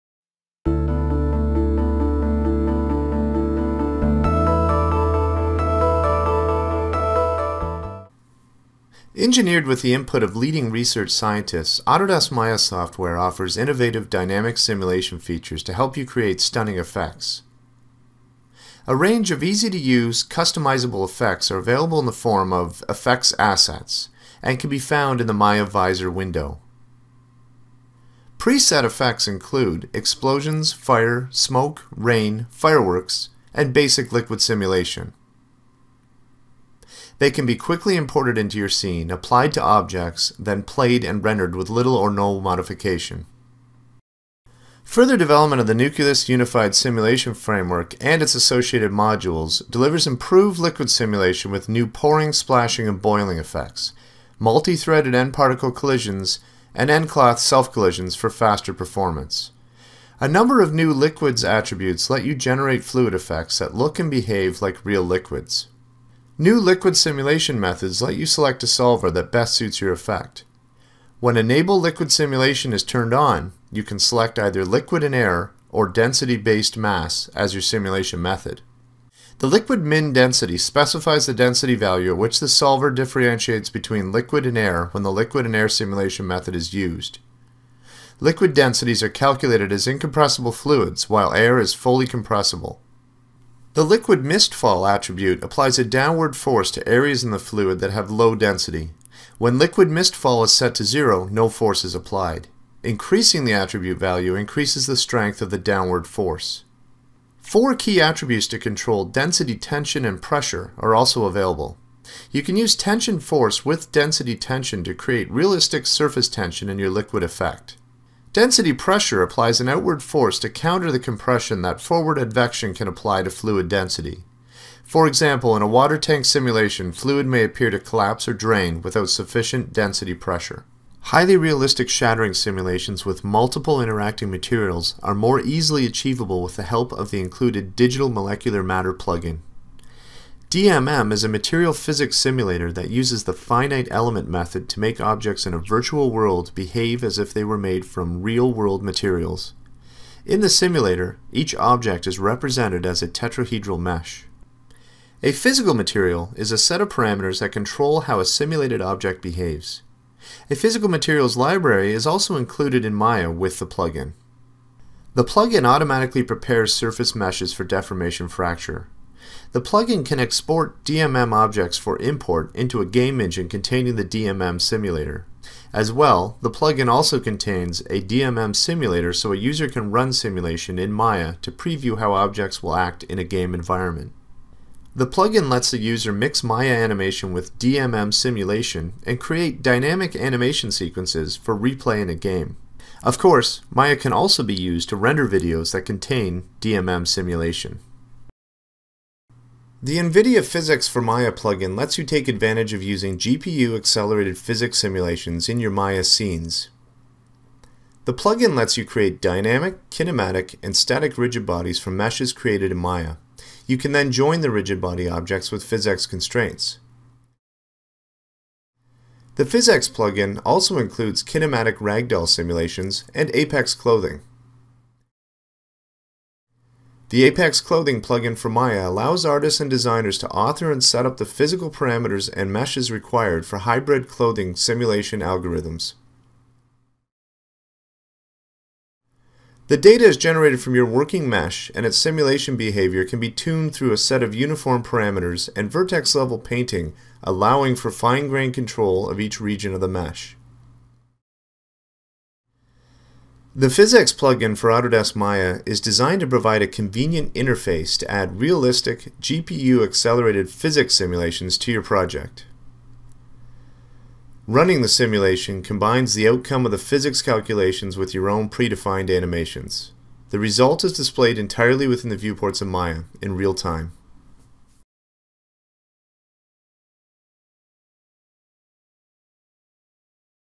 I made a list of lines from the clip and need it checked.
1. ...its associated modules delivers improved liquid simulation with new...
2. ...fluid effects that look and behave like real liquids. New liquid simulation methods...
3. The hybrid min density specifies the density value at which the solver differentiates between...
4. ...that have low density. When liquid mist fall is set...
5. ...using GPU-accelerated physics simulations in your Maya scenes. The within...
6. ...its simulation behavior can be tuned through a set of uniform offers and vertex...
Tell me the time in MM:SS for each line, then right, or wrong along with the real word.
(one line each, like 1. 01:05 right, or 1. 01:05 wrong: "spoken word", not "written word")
1. 00:48 right
2. 01:02 right
3. 01:19 wrong: "liquid", not "hybrid"
4. 01:37 right
5. 03:22 wrong: "plugin", not "within"
6. 04:01 wrong: "parameters", not "offers".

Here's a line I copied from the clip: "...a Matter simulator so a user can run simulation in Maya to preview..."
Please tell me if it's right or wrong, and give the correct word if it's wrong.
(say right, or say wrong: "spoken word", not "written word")
wrong: "DMM", not "Matter".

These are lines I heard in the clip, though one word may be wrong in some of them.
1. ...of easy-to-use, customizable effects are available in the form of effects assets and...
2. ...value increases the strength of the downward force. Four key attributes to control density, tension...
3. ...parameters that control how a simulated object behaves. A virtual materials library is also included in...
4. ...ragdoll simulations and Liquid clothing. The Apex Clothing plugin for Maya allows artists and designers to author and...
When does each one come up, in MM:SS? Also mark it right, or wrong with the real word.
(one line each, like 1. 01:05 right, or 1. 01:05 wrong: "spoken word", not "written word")
1. 00:19 right
2. 01:43 right
3. 02:36 wrong: "physical", not "virtual"
4. 03:41 wrong: "Apex", not "Liquid".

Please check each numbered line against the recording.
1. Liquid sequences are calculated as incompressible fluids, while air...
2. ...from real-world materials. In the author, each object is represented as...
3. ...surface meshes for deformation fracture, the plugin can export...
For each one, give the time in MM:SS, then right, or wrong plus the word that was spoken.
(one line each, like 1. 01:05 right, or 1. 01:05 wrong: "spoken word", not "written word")
1. 01:28 wrong: "densities", not "sequences"
2. 02:27 wrong: "simulator", not "author"
3. 02:46 right.